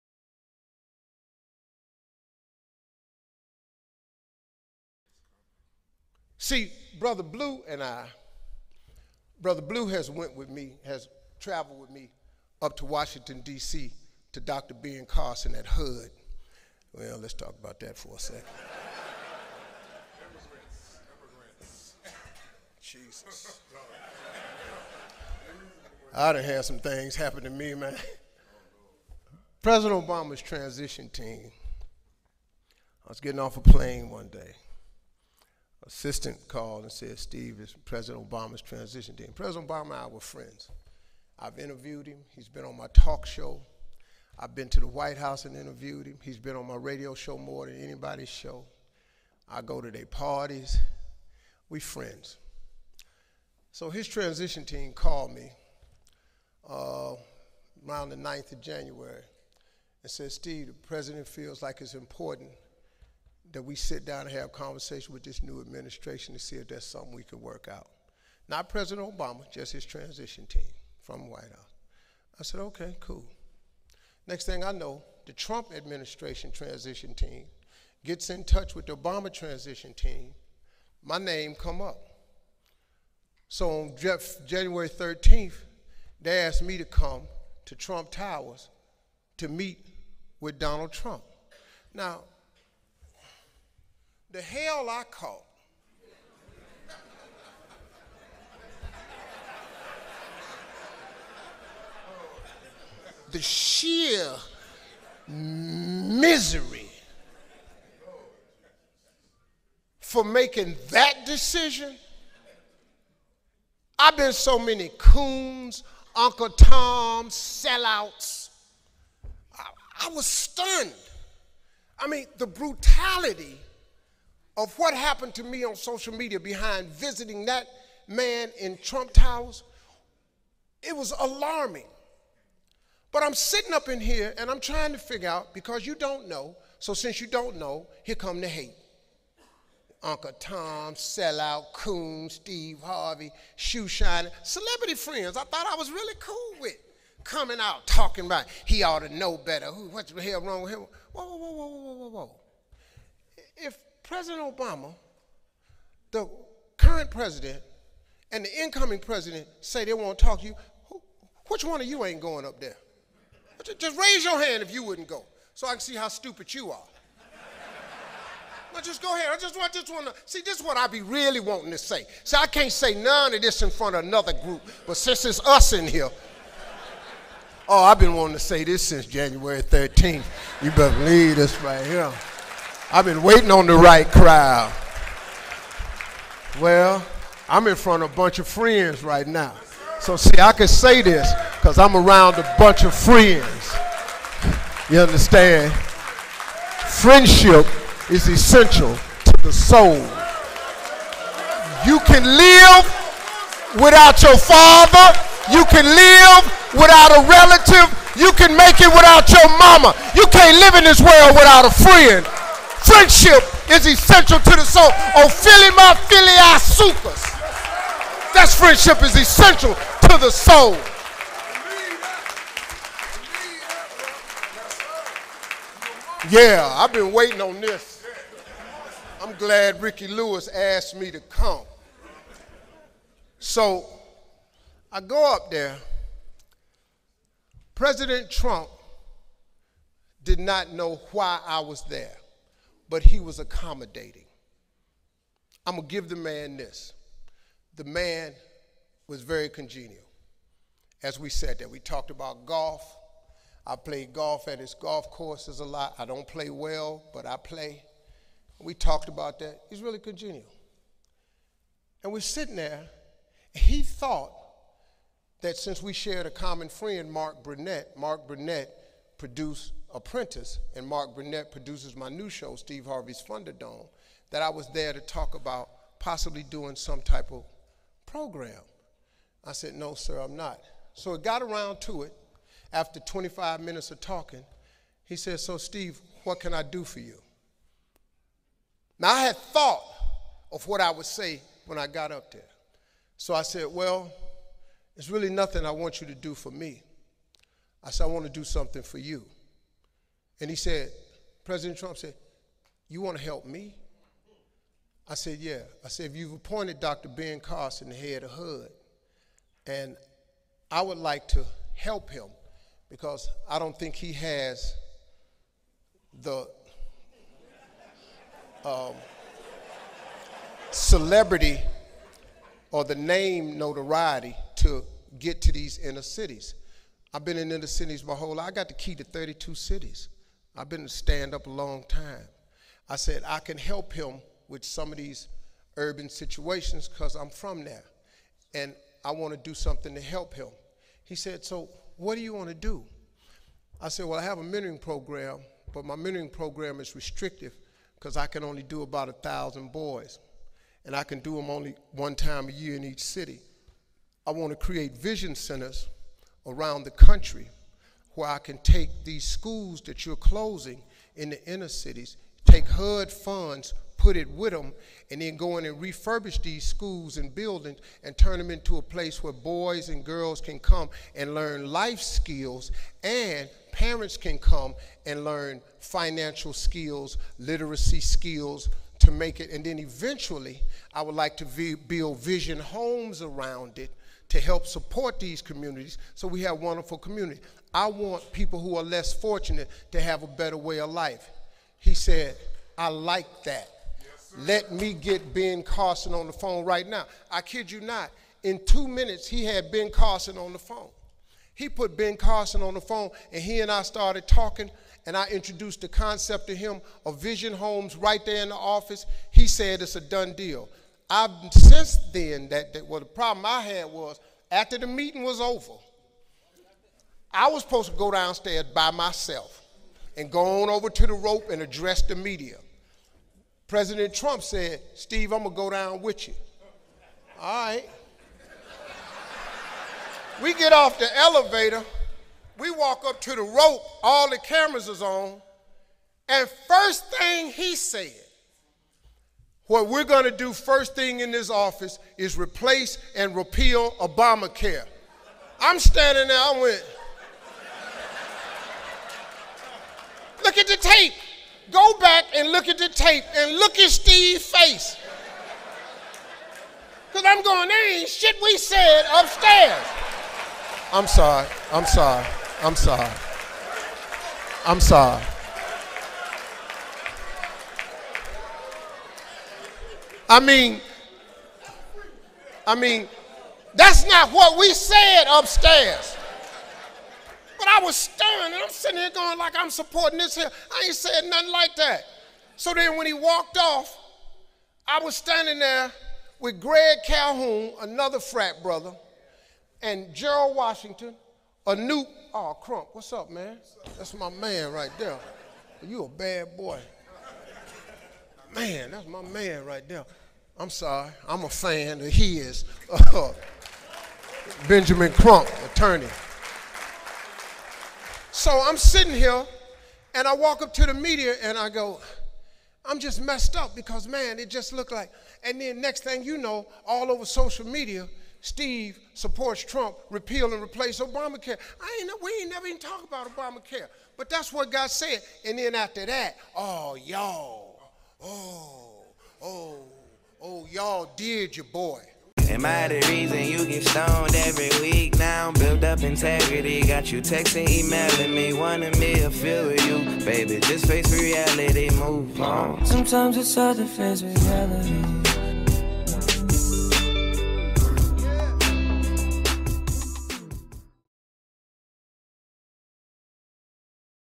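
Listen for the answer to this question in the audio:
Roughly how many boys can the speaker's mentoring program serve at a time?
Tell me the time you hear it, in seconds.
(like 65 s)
349 s.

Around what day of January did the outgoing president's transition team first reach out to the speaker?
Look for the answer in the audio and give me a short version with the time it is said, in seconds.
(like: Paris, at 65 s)
9th, at 58 s.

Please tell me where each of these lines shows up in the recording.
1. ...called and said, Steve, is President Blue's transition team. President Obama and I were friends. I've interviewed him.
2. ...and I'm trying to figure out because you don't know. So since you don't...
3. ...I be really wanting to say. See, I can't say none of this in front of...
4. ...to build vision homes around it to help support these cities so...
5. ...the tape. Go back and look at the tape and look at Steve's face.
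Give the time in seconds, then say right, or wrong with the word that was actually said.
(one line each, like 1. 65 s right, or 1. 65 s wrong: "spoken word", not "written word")
1. 36 s wrong: "Obama", not "Blue"
2. 134 s right
3. 170 s right
4. 381 s wrong: "communities", not "cities"
5. 450 s right.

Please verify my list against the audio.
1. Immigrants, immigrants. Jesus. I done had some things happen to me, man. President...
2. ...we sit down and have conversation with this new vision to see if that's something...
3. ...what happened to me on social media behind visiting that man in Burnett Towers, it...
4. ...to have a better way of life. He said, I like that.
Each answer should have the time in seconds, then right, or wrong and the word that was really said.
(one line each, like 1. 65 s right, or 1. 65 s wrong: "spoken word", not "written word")
1. 20 s right
2. 63 s wrong: "administration", not "vision"
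3. 124 s wrong: "Trump", not "Burnett"
4. 389 s right.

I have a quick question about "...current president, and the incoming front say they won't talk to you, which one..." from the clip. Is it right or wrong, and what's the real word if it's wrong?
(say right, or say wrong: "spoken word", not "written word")
wrong: "president", not "front".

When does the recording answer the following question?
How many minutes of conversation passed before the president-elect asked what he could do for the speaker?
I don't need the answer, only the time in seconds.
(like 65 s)
283 s.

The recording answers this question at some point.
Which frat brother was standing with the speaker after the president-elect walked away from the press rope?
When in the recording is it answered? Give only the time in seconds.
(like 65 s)
486 s.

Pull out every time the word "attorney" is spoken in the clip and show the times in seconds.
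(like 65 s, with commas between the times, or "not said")
505 s.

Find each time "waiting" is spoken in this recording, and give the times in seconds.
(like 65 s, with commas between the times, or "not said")
183 s, 227 s.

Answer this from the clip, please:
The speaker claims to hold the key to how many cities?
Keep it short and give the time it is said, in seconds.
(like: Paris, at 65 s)
32, at 329 s.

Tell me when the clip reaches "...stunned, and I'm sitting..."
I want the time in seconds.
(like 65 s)
477 s.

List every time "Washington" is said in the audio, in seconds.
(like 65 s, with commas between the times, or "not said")
12 s, 490 s.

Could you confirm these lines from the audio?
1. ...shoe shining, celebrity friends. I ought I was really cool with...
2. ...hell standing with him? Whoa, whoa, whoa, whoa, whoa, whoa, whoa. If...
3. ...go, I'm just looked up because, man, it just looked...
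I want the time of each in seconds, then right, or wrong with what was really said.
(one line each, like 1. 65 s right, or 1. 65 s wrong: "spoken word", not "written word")
1. 143 s wrong: "thought", not "ought"
2. 150 s wrong: "wrong", not "standing"
3. 511 s wrong: "messed", not "looked".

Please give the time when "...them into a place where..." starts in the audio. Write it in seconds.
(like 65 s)
368 s.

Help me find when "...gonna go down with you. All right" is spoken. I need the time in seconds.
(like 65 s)
425 s.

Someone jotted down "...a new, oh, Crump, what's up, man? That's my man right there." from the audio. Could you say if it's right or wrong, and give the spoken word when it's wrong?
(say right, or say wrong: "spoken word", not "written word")
right.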